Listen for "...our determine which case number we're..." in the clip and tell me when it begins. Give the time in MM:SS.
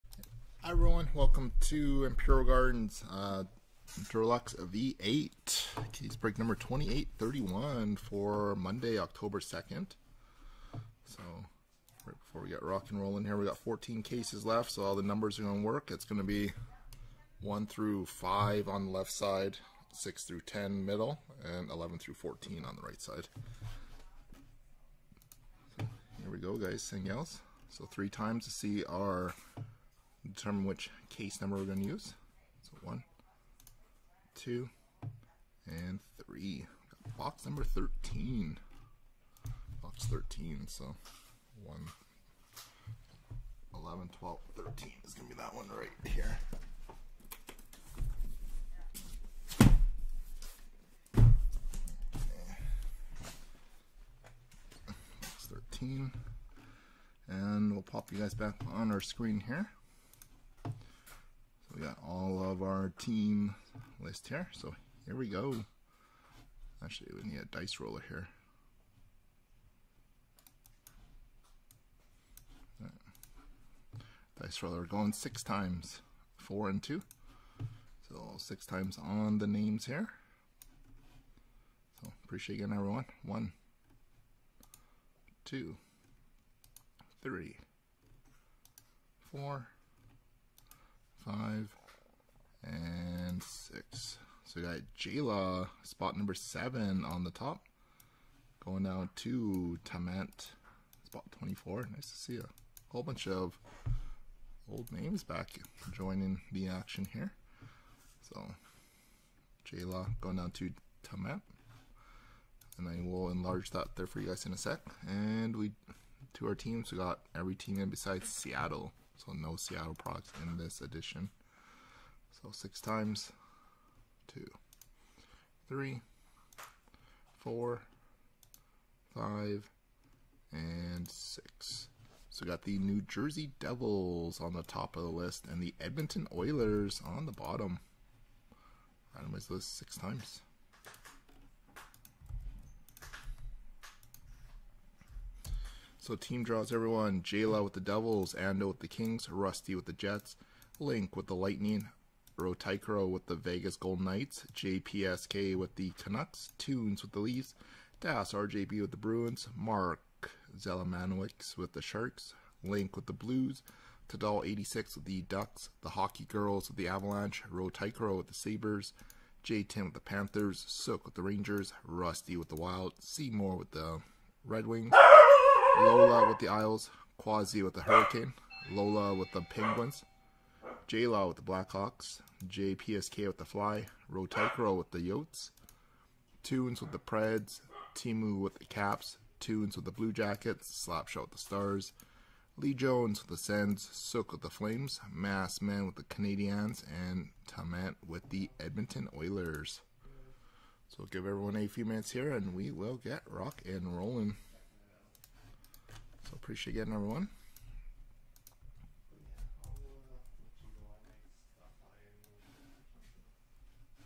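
00:28.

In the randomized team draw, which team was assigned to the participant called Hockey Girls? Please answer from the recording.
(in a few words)
Avalanche.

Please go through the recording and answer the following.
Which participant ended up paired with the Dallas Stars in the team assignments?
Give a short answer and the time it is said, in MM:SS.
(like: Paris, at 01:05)
Slapshot, at 03:10.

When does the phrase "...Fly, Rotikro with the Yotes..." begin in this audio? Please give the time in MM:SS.
03:03.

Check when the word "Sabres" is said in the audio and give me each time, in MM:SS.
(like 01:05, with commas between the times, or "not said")
02:48.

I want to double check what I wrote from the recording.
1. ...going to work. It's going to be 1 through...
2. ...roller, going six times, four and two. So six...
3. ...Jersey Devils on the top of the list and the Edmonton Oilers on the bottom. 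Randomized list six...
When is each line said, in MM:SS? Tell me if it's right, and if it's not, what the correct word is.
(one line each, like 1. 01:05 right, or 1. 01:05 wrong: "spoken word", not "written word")
1. 00:15 right
2. 01:14 right
3. 02:13 right.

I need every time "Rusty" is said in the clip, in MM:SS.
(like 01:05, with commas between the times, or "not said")
02:29, 02:51.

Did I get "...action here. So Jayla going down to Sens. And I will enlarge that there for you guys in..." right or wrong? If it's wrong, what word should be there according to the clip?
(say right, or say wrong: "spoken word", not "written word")
wrong: "Tament", not "Sens".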